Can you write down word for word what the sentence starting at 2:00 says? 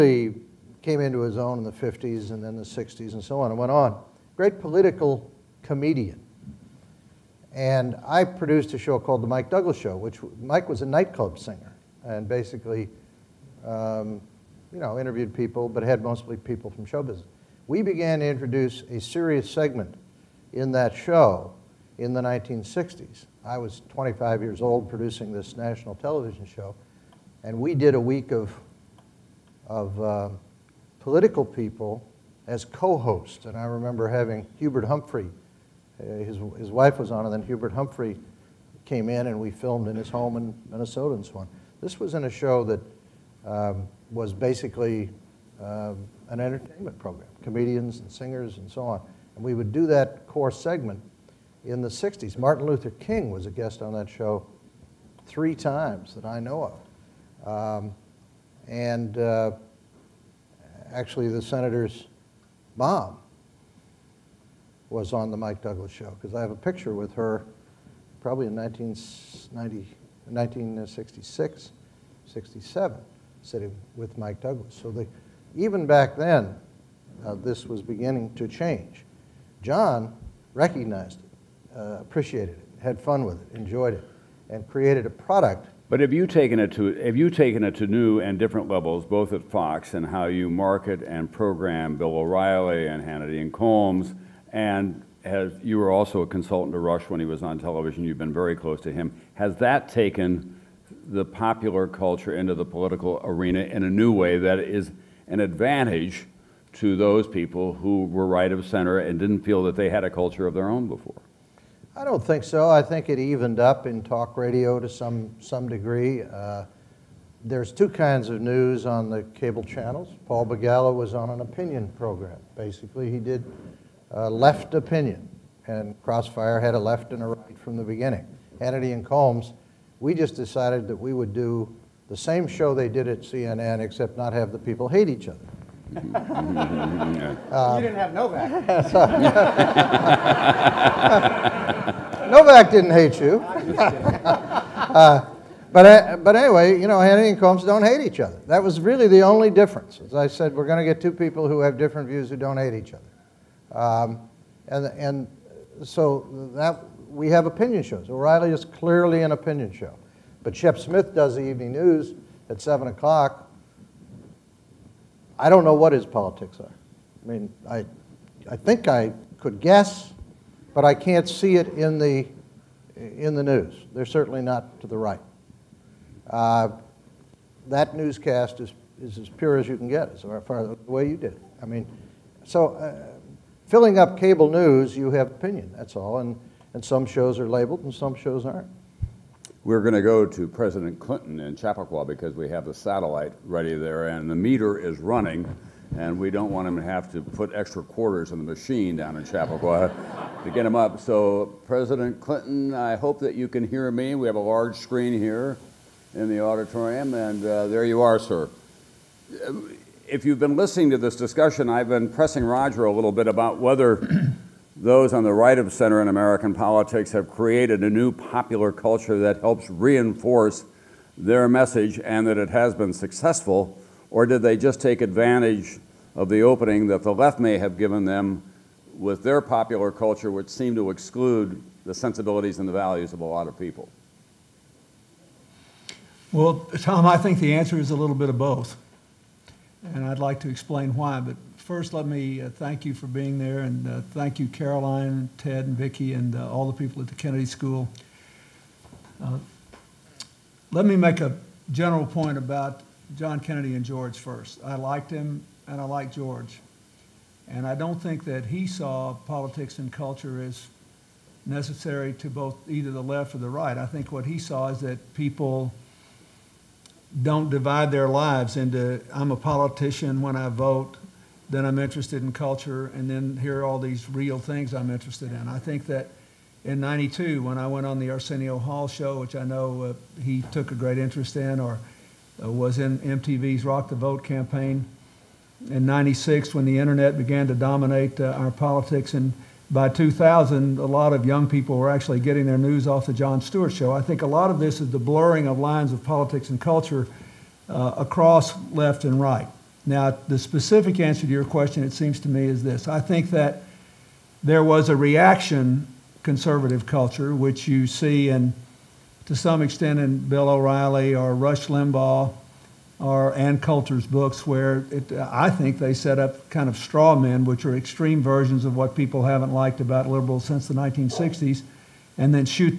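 Paul Begala was on an opinion program.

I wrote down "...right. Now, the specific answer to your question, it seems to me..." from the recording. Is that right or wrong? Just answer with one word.
right.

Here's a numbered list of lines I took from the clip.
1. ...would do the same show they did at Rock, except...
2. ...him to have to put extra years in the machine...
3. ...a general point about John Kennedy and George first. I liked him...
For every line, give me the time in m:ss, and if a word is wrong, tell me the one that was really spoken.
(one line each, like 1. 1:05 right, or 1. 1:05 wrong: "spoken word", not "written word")
1. 2:11 wrong: "CNN", not "Rock"
2. 3:16 wrong: "quarters", not "years"
3. 4:11 right.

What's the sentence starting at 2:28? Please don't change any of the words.
That was really the only difference.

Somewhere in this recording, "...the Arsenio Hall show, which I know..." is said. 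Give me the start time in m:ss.
4:37.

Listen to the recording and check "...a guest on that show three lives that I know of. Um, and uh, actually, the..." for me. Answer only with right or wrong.
wrong.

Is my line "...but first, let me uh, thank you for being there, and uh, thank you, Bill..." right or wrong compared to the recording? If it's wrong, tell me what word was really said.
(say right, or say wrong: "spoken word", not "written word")
wrong: "Caroline", not "Bill".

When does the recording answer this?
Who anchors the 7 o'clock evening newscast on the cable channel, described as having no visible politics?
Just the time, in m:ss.
2:40.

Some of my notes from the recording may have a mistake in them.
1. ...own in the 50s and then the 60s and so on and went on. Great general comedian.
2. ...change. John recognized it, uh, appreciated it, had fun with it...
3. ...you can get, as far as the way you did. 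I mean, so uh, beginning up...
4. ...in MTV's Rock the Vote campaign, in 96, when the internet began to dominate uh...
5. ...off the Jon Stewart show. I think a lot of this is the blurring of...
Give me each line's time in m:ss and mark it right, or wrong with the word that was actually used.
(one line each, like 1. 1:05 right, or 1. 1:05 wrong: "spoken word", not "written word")
1. 0:01 wrong: "political", not "general"
2. 1:18 right
3. 2:59 wrong: "filling", not "beginning"
4. 4:42 right
5. 4:52 right.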